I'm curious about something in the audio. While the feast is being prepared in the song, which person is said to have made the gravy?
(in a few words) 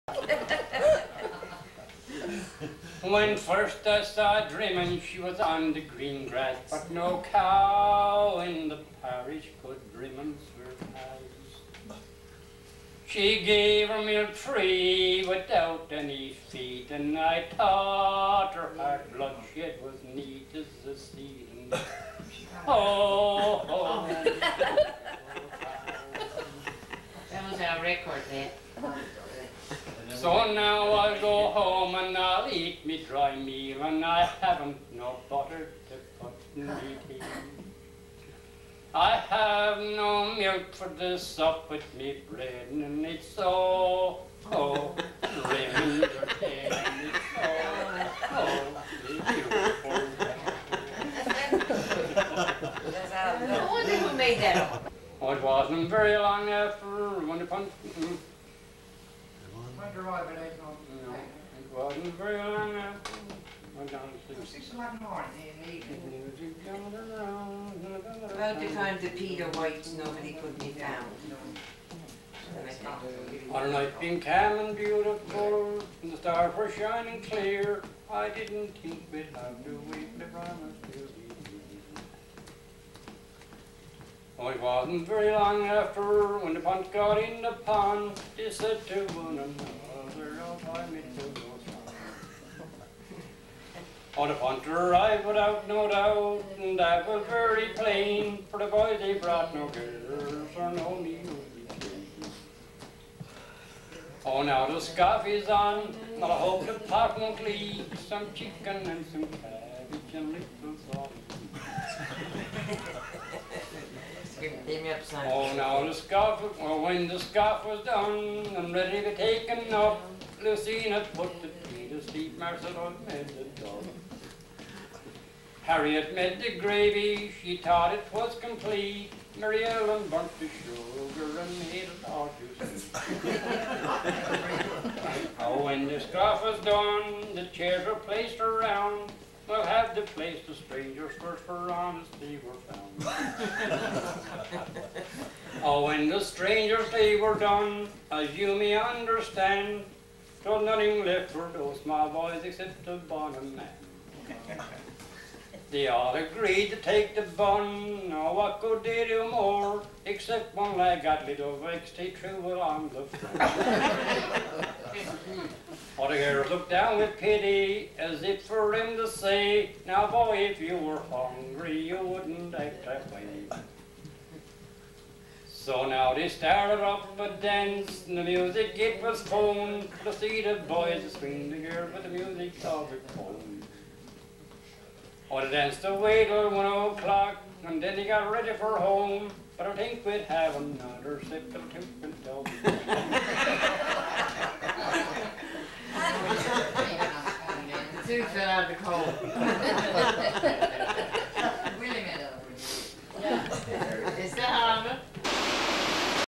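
Harriet.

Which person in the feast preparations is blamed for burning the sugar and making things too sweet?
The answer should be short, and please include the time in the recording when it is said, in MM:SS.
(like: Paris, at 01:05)
Mary Ellen, at 02:09.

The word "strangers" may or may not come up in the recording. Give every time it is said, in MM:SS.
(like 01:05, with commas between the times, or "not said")
02:20, 02:26.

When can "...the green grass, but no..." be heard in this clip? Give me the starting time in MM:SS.
00:05.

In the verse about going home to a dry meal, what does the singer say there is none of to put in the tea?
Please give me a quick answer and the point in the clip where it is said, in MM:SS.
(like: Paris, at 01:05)
butter, at 00:35.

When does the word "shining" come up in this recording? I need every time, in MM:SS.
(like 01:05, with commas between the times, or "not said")
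01:16.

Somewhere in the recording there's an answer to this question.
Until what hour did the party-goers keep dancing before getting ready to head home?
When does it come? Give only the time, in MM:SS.
03:06.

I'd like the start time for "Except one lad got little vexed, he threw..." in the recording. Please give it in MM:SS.
02:40.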